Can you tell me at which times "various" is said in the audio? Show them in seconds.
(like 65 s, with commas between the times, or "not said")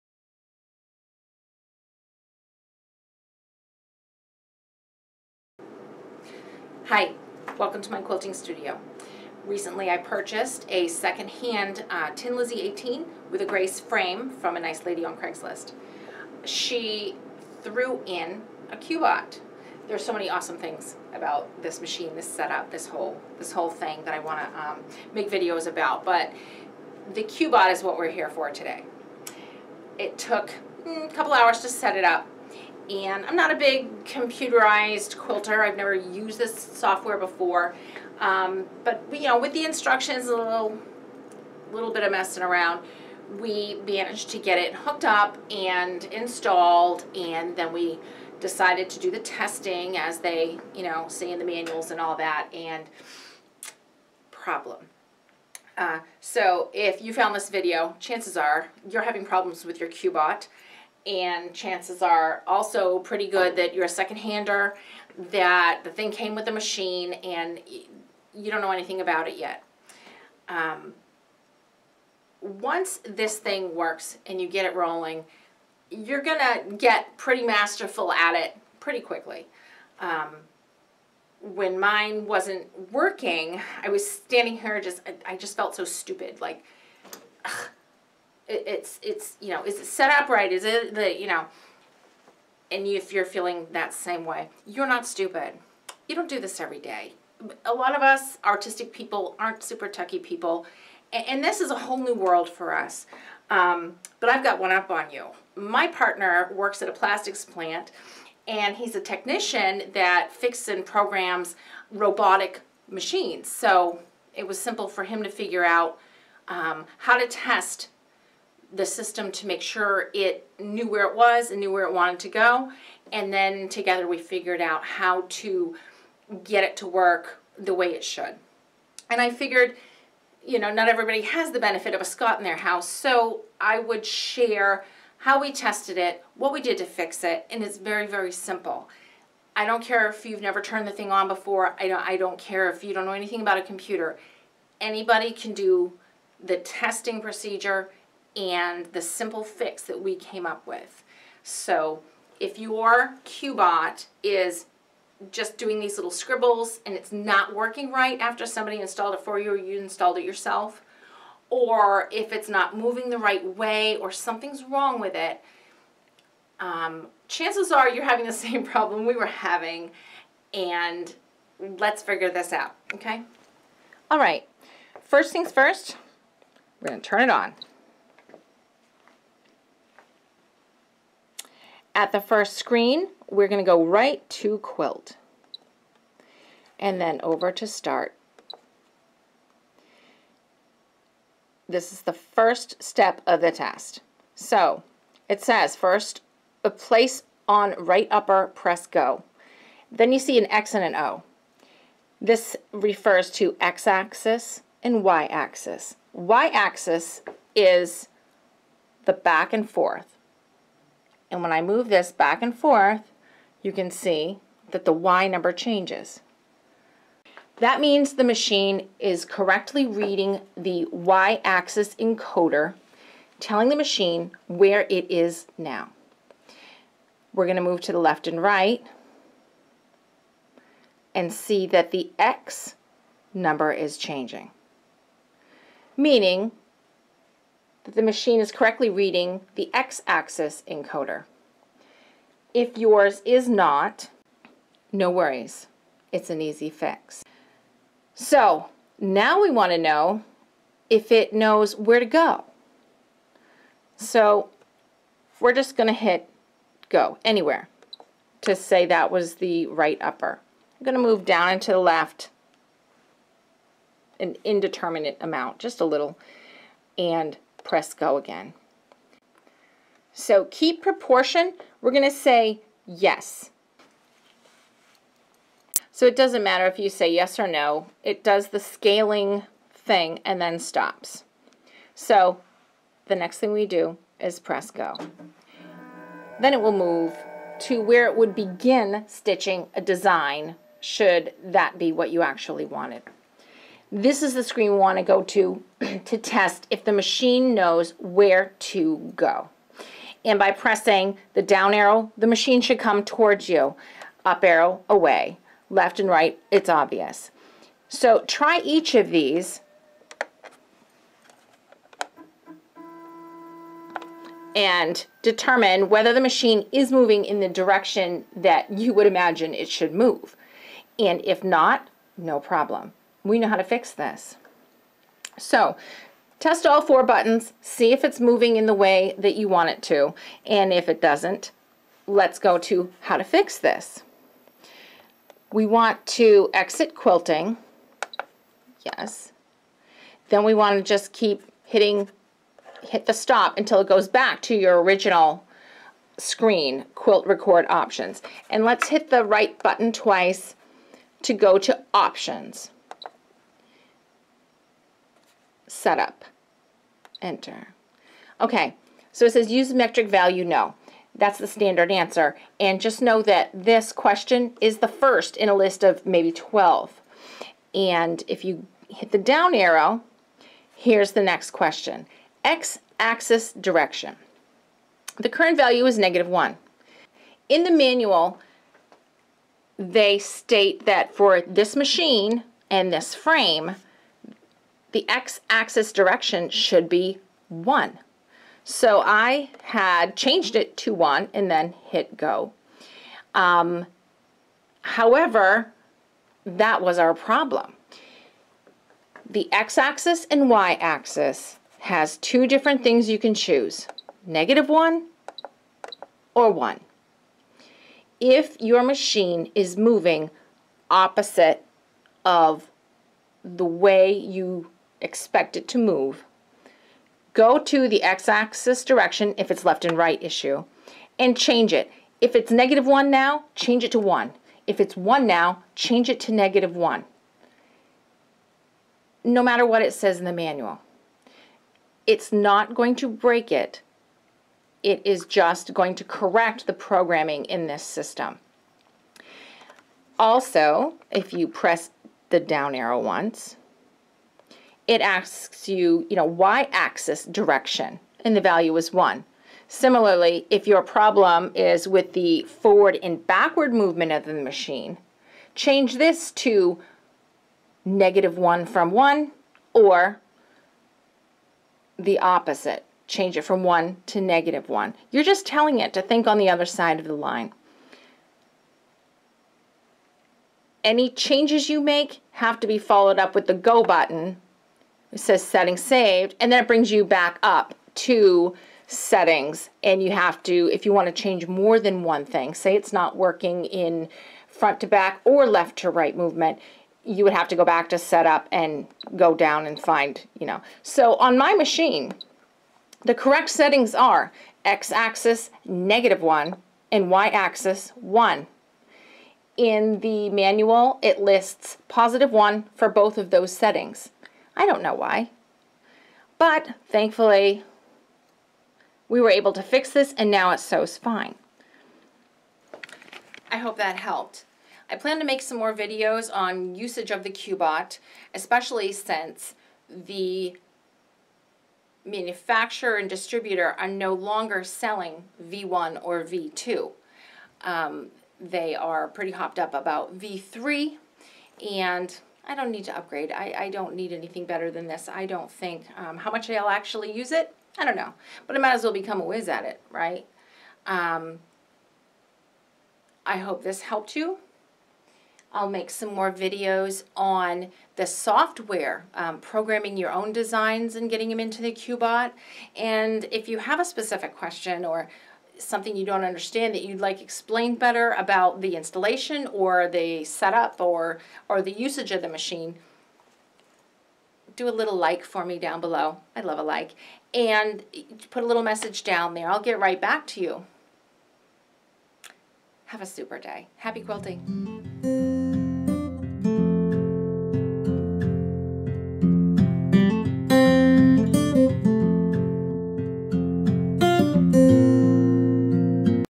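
not said.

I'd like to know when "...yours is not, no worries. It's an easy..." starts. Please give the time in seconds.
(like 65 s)
242 s.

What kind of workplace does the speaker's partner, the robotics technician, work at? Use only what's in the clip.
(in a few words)
Plastics plant.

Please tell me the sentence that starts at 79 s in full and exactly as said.
Um, when mine wasn't working, I was standing here just, I, I just felt so stupid.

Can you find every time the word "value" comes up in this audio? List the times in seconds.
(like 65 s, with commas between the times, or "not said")
360 s, 375 s, 448 s.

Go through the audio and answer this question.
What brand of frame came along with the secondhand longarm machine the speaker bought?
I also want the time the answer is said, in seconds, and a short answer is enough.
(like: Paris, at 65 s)
Grace, at 13 s.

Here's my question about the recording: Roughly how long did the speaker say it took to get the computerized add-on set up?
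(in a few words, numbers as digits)
A couple hours.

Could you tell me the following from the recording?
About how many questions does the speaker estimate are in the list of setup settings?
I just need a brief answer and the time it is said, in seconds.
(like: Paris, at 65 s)
12, at 366 s.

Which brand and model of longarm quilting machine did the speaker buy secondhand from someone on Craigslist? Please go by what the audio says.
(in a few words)
Tin Lizzie 18.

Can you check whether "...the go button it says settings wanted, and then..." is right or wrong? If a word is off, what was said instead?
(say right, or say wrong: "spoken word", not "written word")
wrong: "saved", not "wanted".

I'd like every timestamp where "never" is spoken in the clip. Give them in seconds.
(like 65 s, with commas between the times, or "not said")
35 s, 140 s.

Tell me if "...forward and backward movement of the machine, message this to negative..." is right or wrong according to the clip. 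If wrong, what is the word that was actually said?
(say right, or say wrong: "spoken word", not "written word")
wrong: "change", not "message".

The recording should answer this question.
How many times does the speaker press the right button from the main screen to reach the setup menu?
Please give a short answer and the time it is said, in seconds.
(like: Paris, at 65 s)
Twice, at 349 s.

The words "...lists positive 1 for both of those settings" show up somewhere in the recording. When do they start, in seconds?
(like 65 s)
501 s.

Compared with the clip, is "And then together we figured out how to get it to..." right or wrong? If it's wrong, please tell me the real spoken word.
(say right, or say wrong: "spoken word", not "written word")
right.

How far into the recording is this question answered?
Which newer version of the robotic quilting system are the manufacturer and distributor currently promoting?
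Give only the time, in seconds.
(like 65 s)
530 s.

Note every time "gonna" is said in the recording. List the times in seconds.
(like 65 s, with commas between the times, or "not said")
76 s, 176 s.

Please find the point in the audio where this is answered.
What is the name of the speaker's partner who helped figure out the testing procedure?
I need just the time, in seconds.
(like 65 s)
132 s.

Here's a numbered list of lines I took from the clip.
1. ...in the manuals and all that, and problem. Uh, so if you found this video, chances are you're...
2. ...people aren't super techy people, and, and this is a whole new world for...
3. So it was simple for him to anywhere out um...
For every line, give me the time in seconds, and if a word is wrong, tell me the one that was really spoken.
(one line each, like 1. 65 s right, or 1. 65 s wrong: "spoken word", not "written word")
1. 51 s right
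2. 98 s right
3. 113 s wrong: "figure", not "anywhere".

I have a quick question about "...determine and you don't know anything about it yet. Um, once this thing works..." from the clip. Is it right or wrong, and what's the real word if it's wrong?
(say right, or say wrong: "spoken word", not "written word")
wrong: "machine", not "determine".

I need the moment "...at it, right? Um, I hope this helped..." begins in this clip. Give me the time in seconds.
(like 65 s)
539 s.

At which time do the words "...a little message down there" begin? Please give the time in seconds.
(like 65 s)
568 s.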